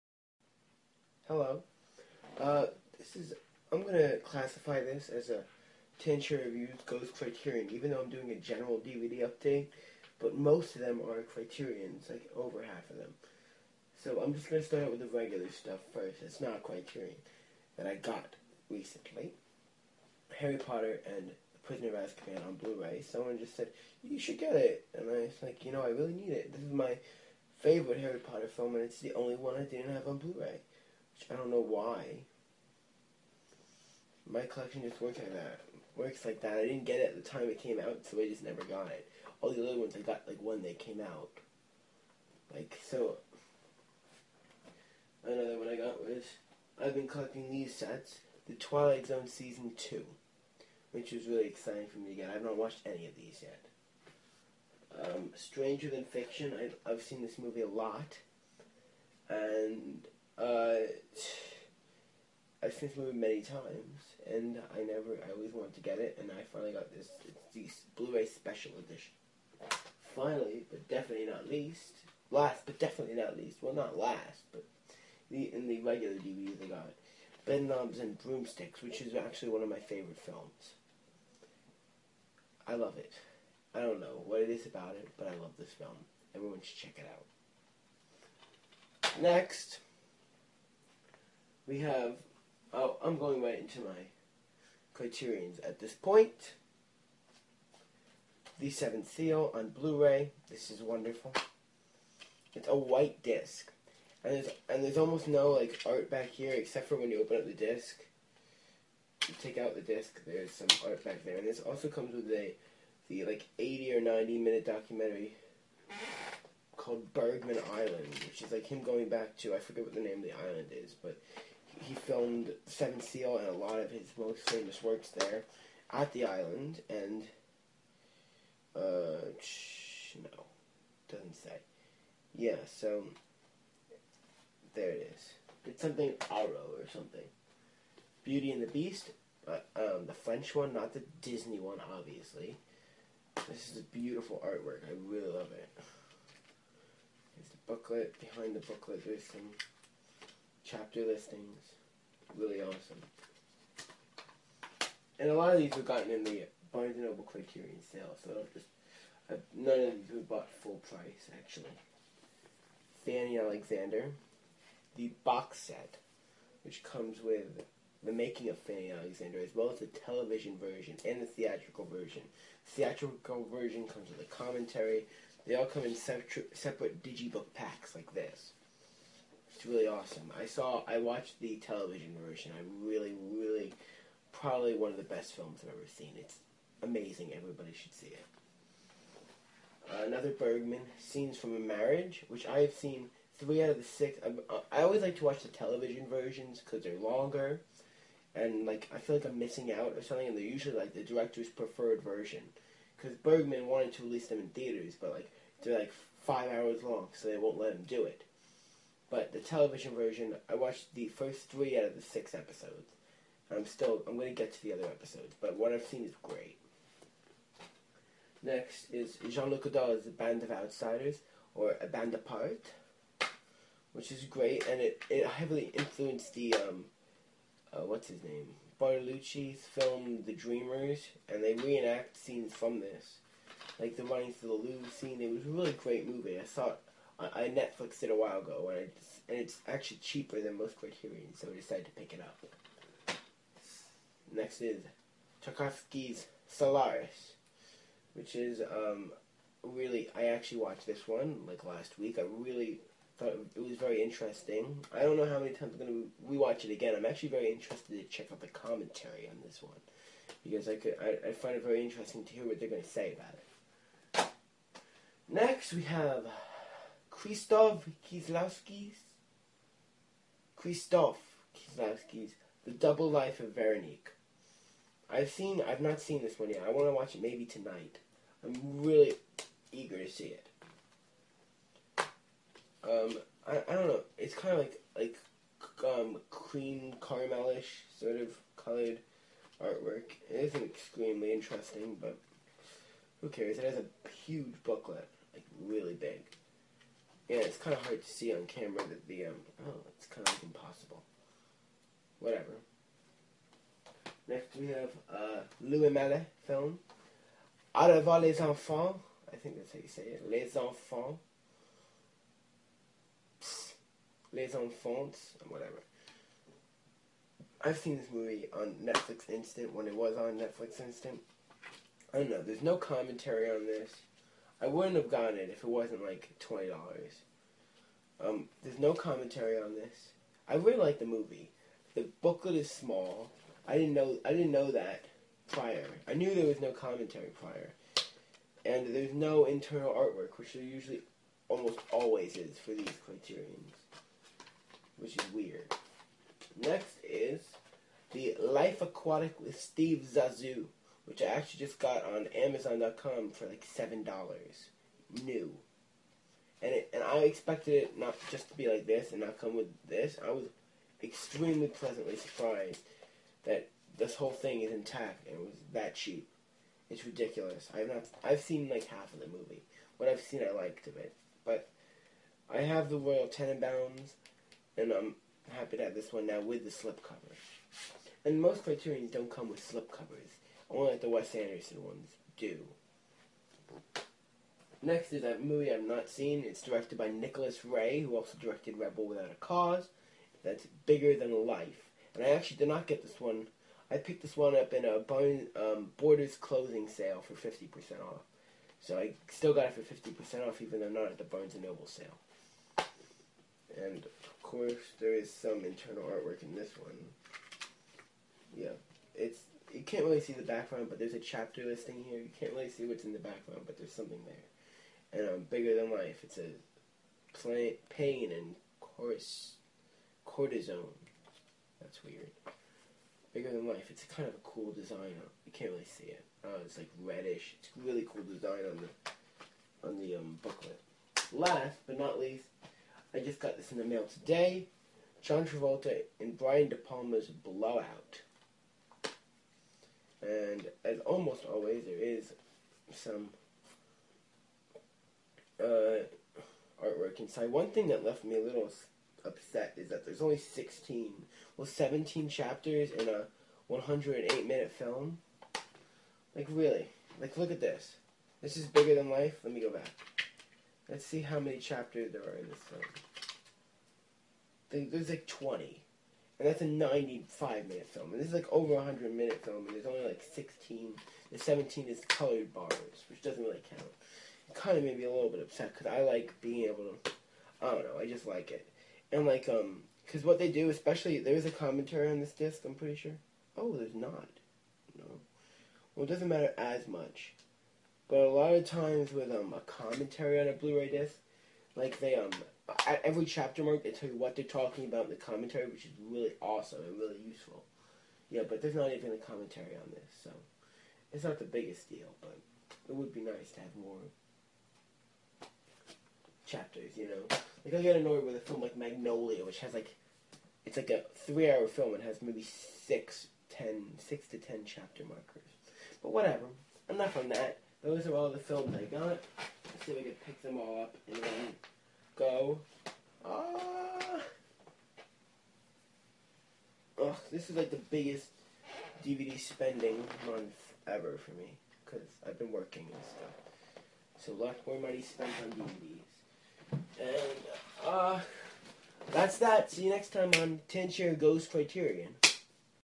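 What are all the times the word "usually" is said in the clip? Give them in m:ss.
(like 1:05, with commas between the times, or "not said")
3:20, 5:40.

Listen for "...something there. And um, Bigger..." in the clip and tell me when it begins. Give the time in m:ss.
6:53.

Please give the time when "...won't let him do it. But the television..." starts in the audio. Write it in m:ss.
3:27.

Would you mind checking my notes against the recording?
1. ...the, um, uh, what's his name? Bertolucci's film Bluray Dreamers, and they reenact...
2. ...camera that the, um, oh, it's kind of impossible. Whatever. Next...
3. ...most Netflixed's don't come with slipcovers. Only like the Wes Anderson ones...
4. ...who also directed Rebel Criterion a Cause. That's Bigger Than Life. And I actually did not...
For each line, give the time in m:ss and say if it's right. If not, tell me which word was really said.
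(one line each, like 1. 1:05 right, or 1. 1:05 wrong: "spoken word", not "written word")
1. 3:46 wrong: "The", not "Bluray"
2. 4:58 right
3. 6:18 wrong: "Criterion", not "Netflixed"
4. 6:28 wrong: "Without", not "Criterion".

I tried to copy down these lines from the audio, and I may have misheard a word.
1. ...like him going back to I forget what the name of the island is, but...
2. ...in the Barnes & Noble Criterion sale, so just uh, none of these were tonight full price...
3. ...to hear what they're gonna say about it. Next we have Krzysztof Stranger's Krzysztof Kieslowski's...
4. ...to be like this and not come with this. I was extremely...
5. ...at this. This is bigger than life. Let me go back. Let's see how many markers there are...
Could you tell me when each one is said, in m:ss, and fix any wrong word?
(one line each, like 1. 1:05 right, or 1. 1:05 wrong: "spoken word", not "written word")
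1. 1:58 right
2. 2:36 wrong: "bought", not "tonight"
3. 4:22 wrong: "Kieslowski", not "Stranger"
4. 5:58 right
5. 7:37 wrong: "chapters", not "markers".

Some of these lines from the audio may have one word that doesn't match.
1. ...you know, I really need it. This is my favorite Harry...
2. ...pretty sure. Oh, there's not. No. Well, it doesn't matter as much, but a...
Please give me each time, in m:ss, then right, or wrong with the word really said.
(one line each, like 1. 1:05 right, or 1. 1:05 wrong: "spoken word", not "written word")
1. 0:25 right
2. 8:02 right.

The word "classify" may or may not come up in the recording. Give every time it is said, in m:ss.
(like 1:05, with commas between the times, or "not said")
0:04.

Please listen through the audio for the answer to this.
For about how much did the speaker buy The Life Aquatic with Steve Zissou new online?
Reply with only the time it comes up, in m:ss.
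5:53.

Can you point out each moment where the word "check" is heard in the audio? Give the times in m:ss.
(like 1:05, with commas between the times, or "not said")
1:26, 4:18.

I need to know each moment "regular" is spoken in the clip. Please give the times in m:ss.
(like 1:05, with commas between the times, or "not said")
0:15, 1:15.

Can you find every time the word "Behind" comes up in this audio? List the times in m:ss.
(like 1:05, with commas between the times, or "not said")
2:28.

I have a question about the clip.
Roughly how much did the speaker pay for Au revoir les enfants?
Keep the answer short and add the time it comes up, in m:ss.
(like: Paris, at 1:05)
$20, at 5:26.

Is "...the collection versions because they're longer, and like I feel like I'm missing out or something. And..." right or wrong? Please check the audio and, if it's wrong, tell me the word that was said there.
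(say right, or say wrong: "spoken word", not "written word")
wrong: "television", not "collection".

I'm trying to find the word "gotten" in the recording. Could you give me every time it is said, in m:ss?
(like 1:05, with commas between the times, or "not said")
2:35, 5:25.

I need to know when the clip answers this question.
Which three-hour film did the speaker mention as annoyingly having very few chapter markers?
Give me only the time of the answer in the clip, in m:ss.
8:28.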